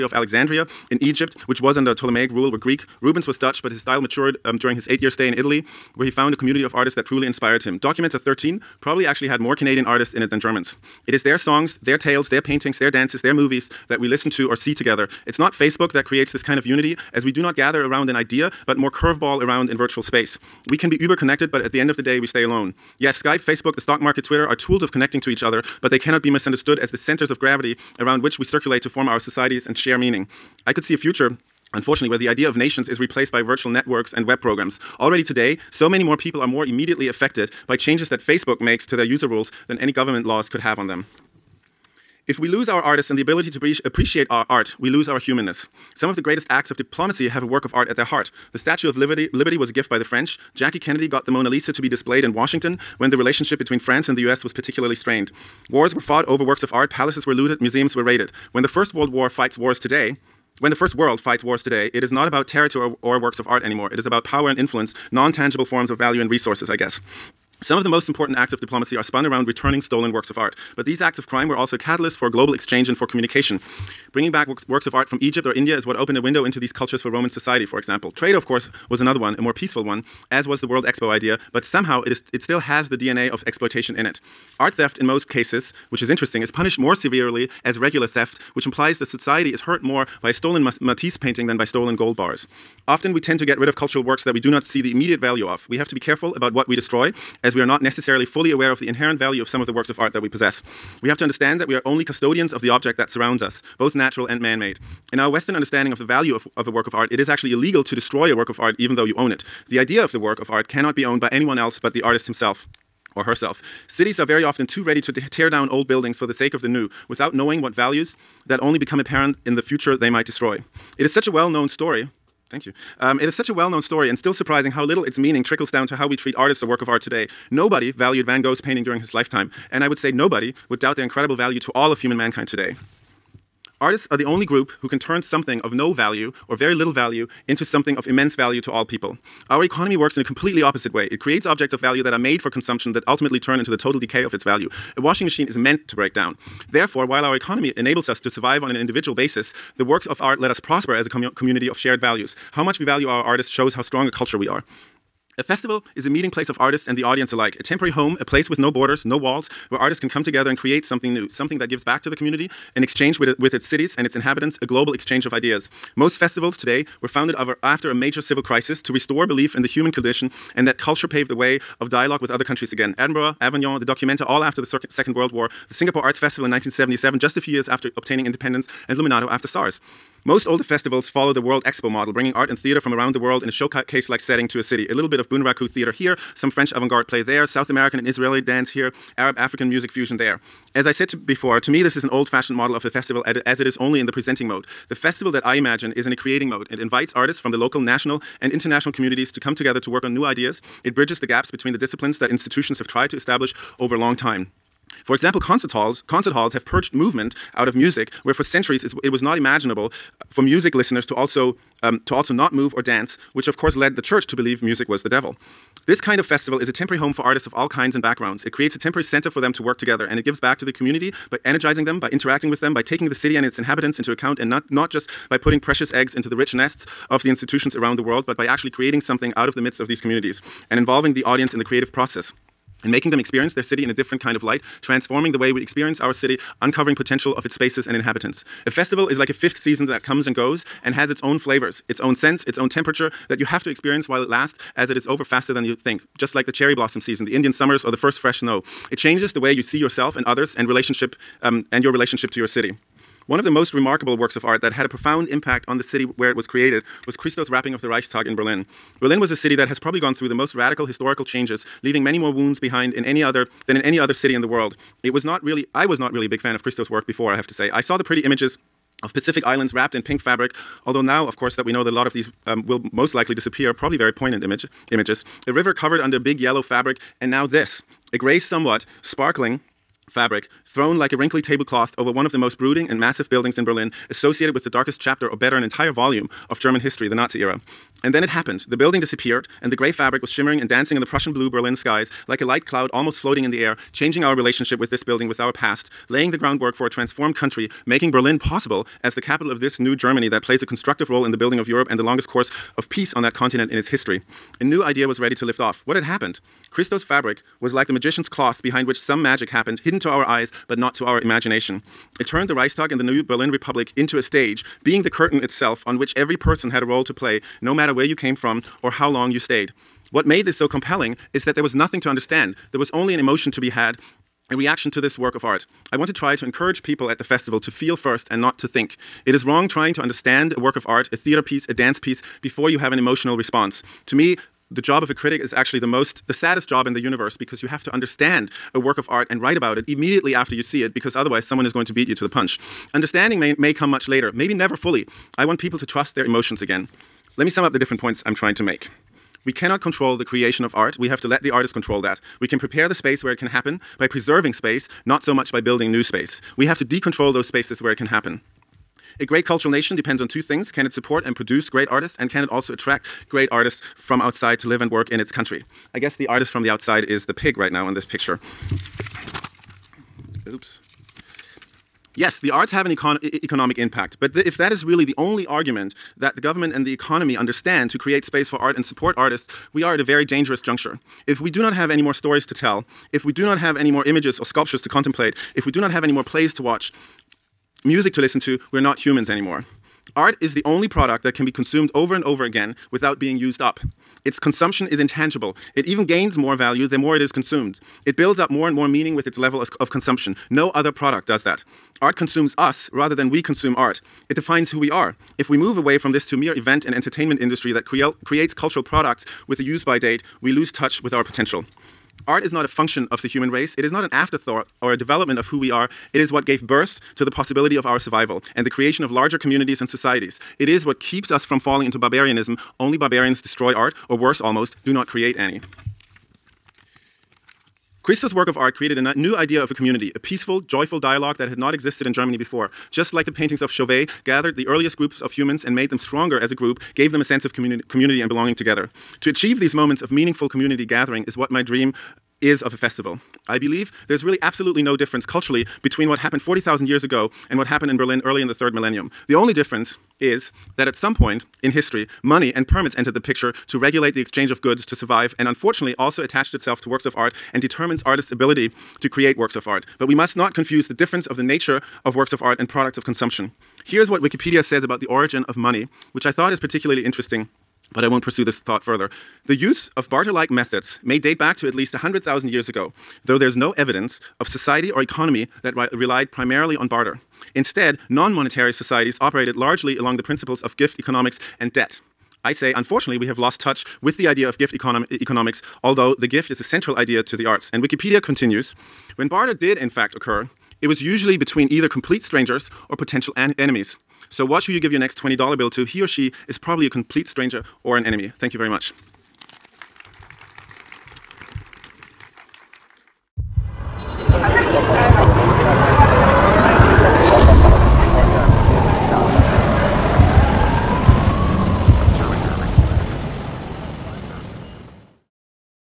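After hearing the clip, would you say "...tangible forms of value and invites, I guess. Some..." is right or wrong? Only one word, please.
wrong.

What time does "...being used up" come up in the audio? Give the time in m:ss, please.
6:33.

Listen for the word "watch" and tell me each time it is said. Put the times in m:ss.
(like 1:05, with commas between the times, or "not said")
6:26, 8:14.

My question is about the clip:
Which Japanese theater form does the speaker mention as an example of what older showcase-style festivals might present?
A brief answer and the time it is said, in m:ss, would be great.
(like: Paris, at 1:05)
Bunraku, at 3:05.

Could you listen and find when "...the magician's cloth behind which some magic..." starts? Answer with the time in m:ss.
5:07.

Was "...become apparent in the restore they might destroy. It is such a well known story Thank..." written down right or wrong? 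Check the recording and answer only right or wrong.
wrong.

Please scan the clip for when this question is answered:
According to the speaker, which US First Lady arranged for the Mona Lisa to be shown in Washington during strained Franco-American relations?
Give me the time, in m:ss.
0:50.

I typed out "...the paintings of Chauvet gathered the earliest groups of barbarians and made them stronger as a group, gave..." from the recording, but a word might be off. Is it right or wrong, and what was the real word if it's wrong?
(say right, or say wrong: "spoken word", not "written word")
wrong: "humans", not "barbarians".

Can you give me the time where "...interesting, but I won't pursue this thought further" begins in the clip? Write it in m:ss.
7:47.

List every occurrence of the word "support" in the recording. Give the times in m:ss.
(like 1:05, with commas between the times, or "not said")
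6:00, 6:18.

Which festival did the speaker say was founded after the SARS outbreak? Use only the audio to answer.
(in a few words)
Luminato.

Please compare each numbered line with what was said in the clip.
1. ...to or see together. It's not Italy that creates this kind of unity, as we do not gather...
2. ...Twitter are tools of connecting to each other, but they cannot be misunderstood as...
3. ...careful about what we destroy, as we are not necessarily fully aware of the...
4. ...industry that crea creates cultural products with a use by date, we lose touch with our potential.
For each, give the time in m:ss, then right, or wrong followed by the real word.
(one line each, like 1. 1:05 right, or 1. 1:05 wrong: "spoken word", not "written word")
1. 0:14 wrong: "Facebook", not "Italy"
2. 0:24 right
3. 1:35 right
4. 6:47 right.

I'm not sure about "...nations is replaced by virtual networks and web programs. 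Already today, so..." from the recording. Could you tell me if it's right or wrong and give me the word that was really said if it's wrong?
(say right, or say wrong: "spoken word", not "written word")
right.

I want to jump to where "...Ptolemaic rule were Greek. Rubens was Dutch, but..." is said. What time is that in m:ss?
0:01.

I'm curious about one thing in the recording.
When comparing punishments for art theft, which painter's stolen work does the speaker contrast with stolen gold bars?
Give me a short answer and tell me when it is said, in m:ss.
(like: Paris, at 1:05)
Matisse, at 1:30.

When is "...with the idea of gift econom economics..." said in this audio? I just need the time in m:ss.
8:04.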